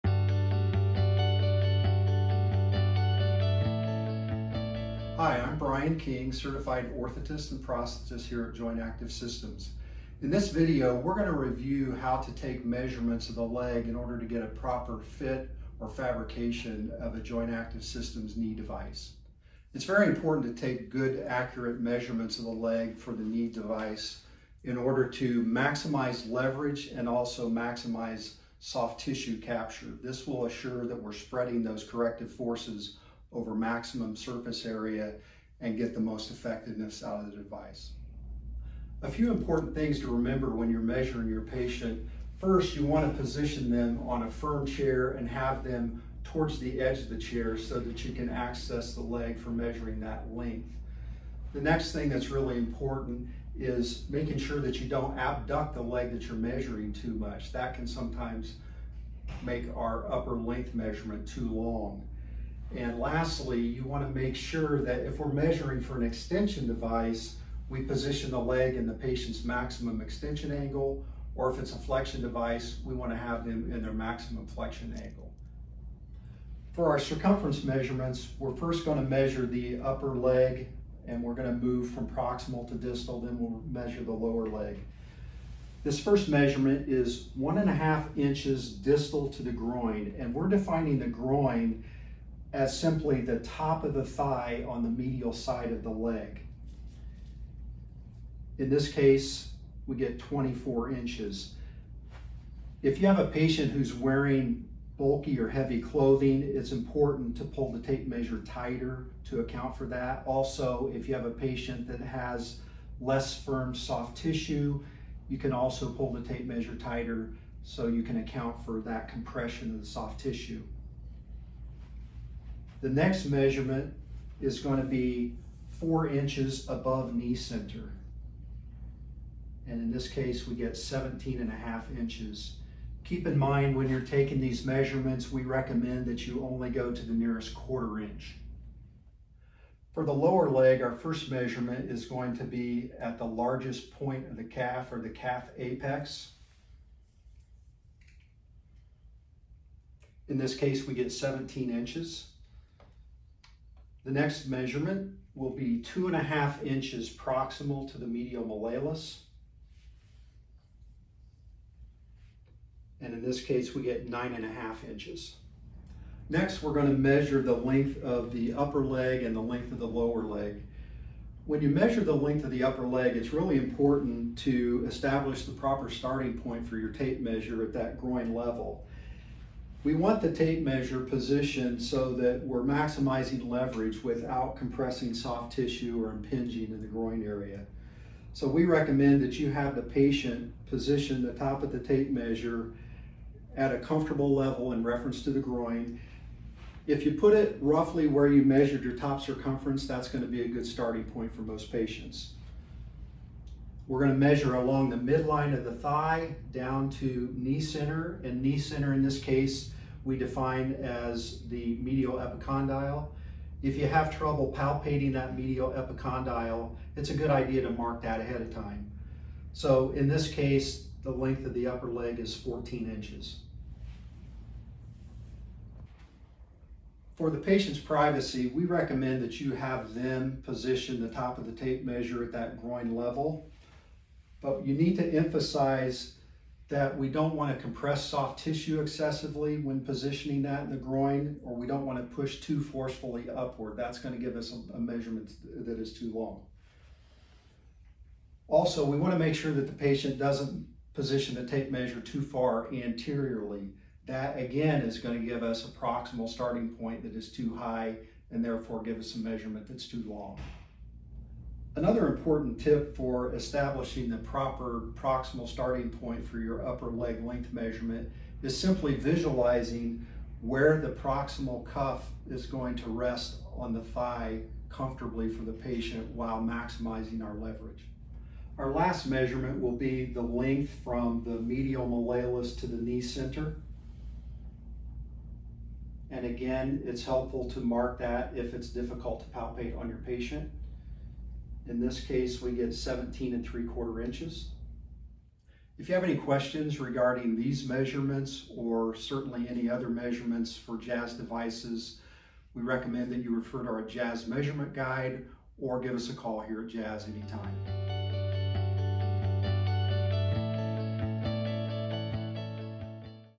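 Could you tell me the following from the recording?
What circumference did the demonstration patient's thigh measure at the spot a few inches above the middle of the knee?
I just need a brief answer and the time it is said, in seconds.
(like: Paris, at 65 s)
17.5 inches, at 130 s.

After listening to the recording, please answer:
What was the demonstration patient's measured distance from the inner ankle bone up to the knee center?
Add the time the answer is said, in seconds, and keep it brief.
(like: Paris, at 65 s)
17.75 inches, at 292 s.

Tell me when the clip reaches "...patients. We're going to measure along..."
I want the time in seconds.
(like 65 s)
201 s.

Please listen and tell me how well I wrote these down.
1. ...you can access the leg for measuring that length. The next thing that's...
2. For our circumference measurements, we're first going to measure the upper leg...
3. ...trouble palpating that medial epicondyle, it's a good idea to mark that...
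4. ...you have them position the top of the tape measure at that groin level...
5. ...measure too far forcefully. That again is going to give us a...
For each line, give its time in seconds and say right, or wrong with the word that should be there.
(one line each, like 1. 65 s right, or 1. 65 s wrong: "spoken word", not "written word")
1. 48 s right
2. 76 s right
3. 214 s right
4. 229 s right
5. 251 s wrong: "anteriorly", not "forcefully".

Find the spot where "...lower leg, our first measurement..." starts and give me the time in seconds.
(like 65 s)
140 s.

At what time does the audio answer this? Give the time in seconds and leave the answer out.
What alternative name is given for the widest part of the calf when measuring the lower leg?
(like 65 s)
145 s.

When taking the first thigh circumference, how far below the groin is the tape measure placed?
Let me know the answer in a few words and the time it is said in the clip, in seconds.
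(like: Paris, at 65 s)
1.5 inches, at 87 s.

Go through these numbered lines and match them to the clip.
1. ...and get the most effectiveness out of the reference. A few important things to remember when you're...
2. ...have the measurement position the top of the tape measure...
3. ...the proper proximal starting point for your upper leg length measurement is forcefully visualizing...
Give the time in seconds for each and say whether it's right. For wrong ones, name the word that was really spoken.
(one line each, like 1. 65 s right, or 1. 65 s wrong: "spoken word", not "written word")
1. 35 s wrong: "device", not "reference"
2. 189 s wrong: "patient", not "measurement"
3. 264 s wrong: "simply", not "forcefully".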